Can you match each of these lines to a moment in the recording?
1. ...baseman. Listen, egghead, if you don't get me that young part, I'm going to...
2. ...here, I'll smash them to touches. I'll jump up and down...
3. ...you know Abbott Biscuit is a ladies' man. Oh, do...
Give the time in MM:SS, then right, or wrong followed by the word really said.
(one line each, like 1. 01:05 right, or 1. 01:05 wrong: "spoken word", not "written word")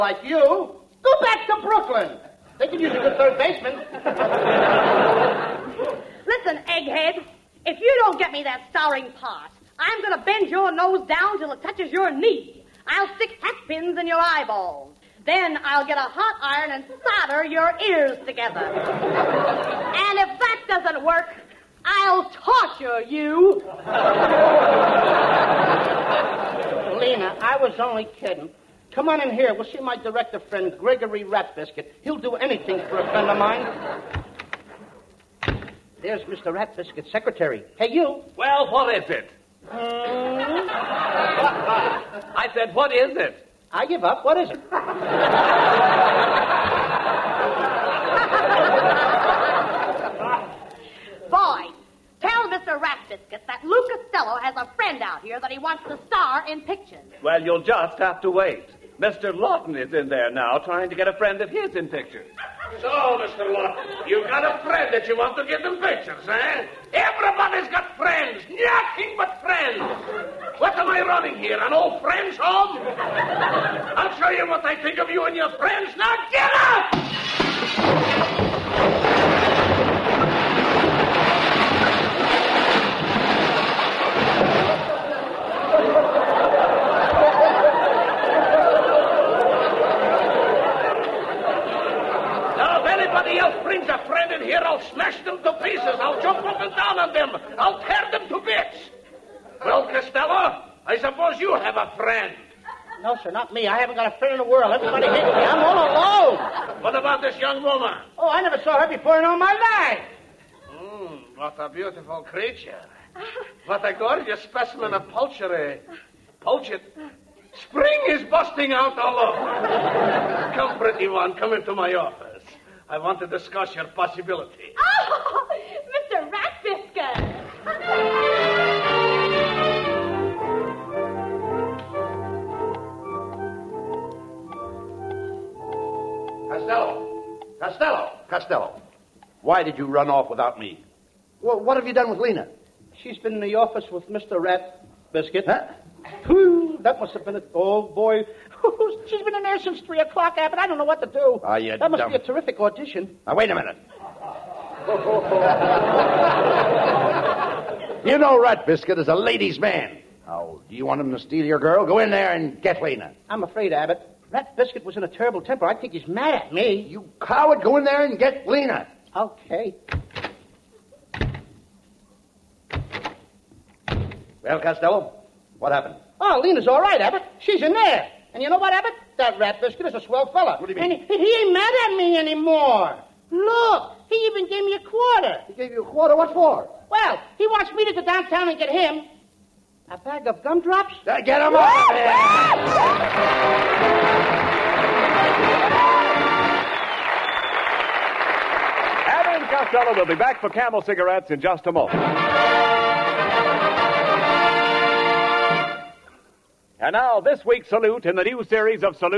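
1. 00:03 wrong: "starring", not "young"
2. 01:34 wrong: "pieces", not "touches"
3. 02:38 wrong: "Rat", not "Abbott".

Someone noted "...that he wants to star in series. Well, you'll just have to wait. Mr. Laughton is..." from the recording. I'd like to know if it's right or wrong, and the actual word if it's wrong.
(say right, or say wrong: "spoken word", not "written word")
wrong: "pictures", not "series".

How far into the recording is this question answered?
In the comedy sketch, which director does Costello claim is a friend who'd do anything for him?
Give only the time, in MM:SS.
00:30.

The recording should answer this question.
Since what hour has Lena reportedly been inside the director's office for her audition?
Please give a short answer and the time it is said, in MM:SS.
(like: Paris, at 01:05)
3 o'clock, at 02:29.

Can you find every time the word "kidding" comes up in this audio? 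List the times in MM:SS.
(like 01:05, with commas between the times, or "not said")
00:28.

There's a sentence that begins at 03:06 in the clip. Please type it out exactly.
Well, he wants me to go downtown and get him a bag of gumdrops.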